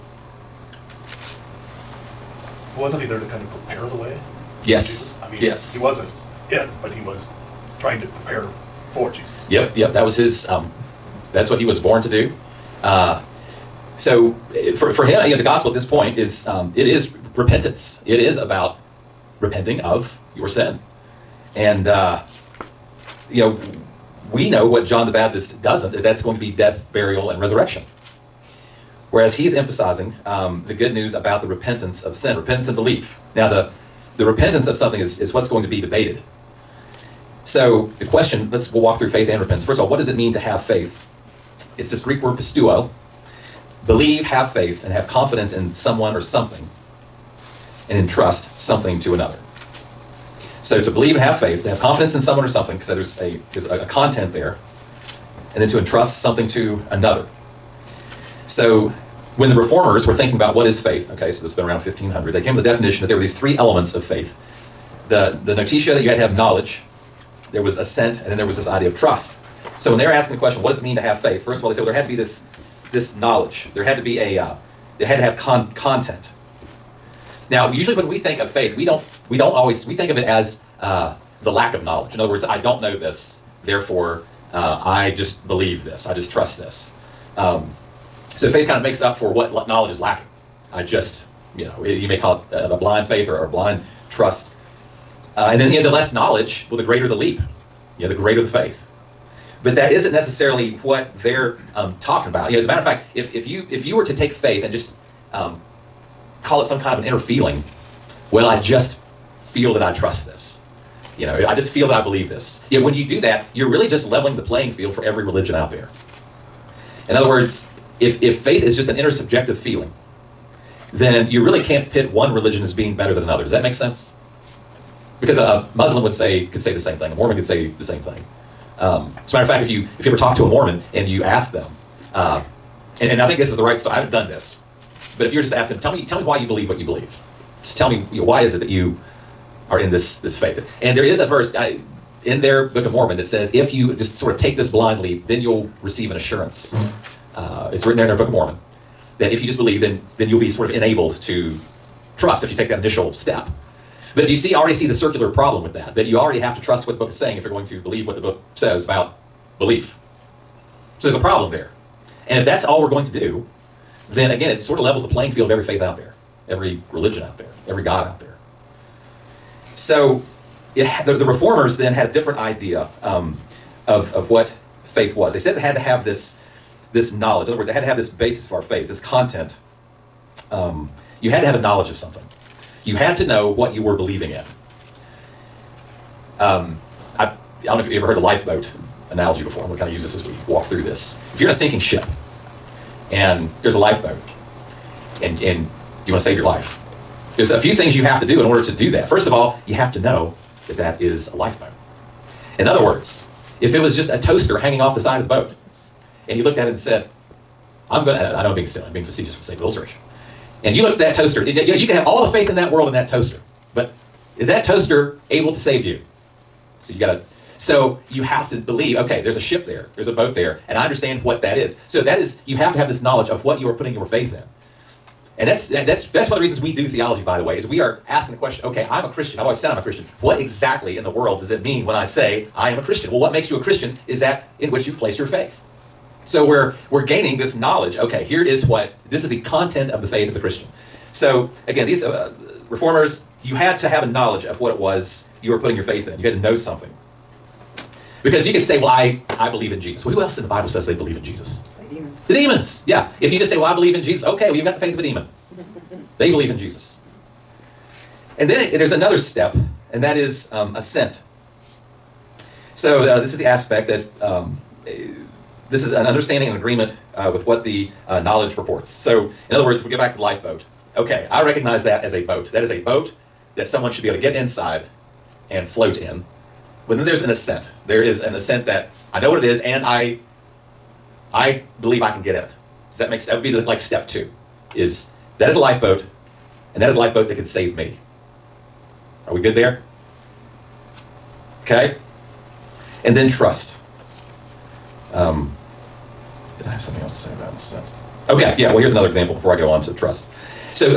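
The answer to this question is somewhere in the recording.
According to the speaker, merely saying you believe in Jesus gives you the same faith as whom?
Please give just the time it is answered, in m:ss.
4:14.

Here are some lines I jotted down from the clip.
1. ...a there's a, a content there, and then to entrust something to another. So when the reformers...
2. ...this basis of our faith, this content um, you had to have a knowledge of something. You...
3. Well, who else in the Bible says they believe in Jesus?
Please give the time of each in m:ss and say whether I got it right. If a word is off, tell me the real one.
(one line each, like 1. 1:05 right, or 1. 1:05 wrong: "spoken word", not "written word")
1. 0:53 right
2. 2:57 right
3. 4:10 right.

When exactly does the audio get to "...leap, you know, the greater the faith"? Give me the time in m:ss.
1:37.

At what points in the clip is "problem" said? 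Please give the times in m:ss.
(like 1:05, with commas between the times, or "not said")
2:35, 2:41.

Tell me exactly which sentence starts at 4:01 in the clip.
So again, these uh, uh, reformers, you had to have a knowledge of what it was you were putting your faith in.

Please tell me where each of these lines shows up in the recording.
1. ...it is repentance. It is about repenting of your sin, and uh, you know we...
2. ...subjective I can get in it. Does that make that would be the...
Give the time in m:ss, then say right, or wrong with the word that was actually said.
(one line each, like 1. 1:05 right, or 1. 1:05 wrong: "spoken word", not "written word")
1. 0:16 right
2. 4:41 wrong: "believe", not "subjective".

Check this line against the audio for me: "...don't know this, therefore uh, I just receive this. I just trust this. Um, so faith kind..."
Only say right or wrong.
wrong.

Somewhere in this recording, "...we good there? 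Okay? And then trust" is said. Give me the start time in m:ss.
4:49.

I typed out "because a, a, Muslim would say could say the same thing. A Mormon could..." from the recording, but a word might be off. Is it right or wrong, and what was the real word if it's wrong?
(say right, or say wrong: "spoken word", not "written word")
right.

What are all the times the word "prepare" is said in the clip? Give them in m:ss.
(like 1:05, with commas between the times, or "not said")
0:03, 0:08.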